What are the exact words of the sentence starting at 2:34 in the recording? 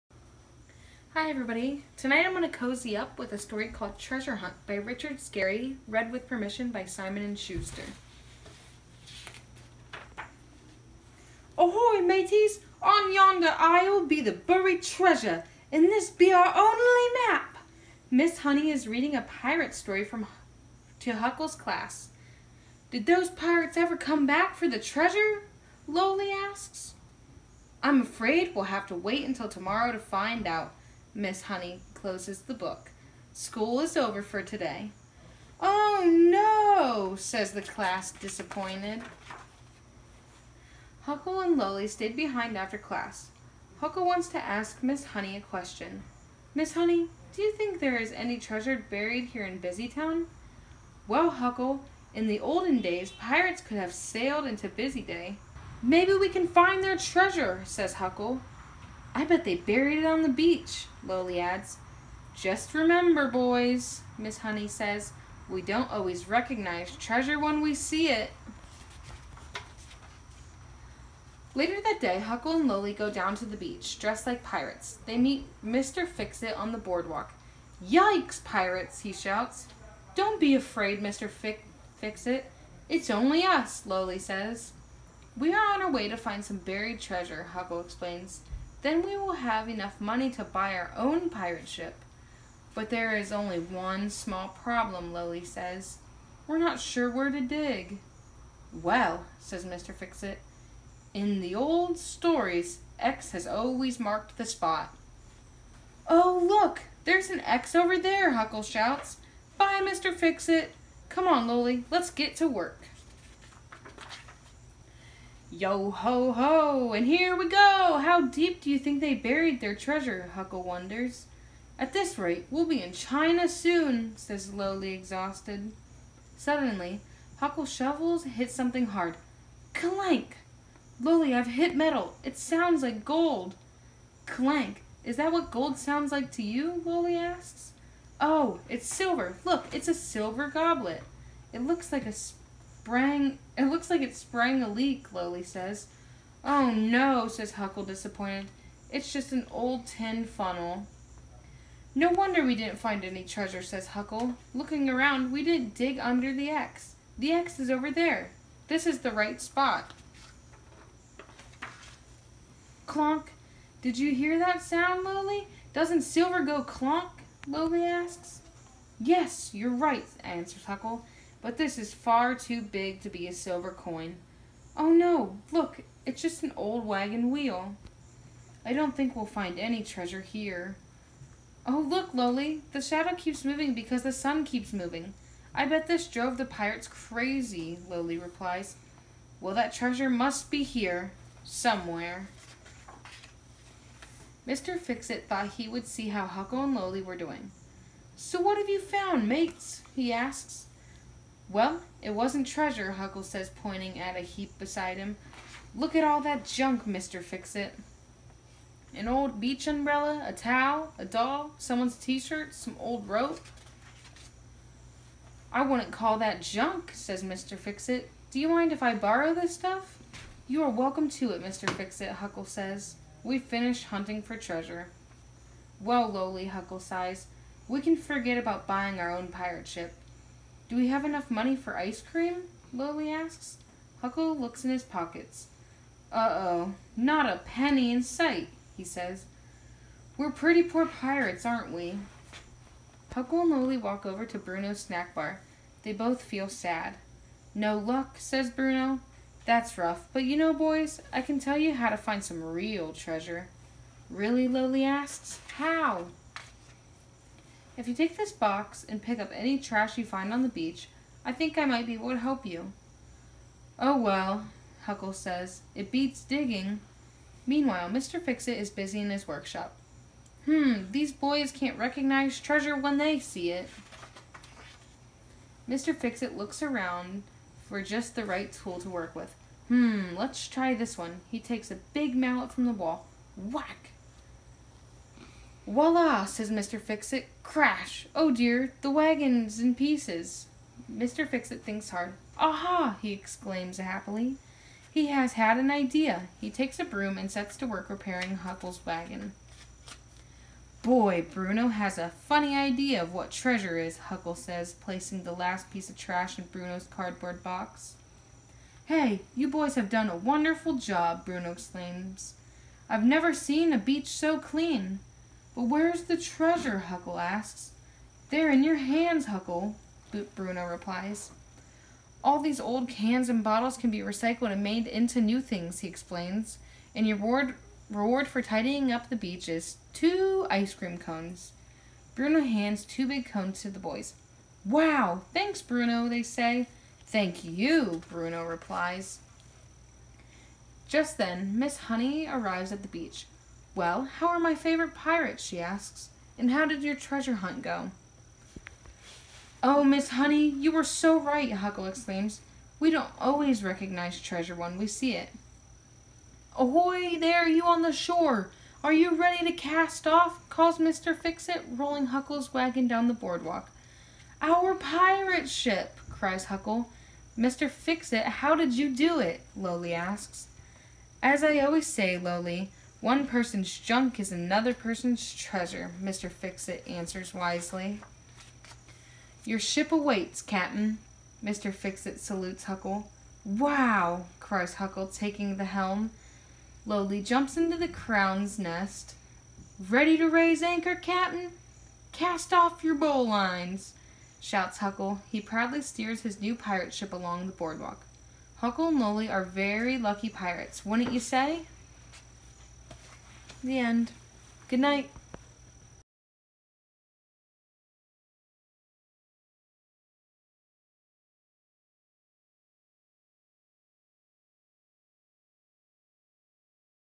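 Looking around, we didn't dig under the X.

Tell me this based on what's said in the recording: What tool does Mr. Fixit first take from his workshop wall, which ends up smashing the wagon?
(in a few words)
a big mallet.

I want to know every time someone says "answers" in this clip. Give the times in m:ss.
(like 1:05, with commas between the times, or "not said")
2:50, 6:16.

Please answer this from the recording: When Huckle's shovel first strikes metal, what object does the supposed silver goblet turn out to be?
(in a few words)
an old tin funnel.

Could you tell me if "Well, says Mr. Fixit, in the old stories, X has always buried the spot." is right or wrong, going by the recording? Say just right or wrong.
wrong.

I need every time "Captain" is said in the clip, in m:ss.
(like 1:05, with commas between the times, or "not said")
6:20, 6:30.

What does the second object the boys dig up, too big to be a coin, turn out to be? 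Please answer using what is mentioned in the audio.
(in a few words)
an old wagon wheel.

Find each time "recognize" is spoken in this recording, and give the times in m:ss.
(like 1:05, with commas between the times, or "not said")
1:06, 4:31, 5:53.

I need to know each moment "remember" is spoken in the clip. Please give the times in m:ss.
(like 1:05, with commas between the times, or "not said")
1:02.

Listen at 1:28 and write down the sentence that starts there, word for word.
Then we will have enough money to buy our own pirate ship.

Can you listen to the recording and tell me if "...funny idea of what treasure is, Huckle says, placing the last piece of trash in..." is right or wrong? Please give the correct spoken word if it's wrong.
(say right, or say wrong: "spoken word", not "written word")
right.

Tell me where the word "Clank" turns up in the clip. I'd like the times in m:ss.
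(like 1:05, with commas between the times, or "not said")
2:09, 2:14.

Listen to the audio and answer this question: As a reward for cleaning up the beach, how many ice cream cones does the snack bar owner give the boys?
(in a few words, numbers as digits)
2.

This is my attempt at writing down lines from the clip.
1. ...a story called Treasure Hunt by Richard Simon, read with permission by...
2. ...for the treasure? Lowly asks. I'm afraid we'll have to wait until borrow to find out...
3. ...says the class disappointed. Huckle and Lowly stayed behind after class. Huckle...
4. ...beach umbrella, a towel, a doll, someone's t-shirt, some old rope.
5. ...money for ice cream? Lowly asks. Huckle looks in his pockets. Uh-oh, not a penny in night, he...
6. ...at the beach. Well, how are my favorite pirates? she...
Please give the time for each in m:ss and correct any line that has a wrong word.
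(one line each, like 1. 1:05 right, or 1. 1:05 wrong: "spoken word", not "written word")
1. 0:03 wrong: "Scarry", not "Simon"
2. 0:24 wrong: "tomorrow", not "borrow"
3. 0:37 right
4. 3:29 right
5. 3:51 wrong: "sight", not "night"
6. 5:42 right.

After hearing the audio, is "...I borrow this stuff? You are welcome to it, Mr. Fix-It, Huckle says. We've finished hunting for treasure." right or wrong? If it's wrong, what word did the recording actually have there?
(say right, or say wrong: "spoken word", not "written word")
right.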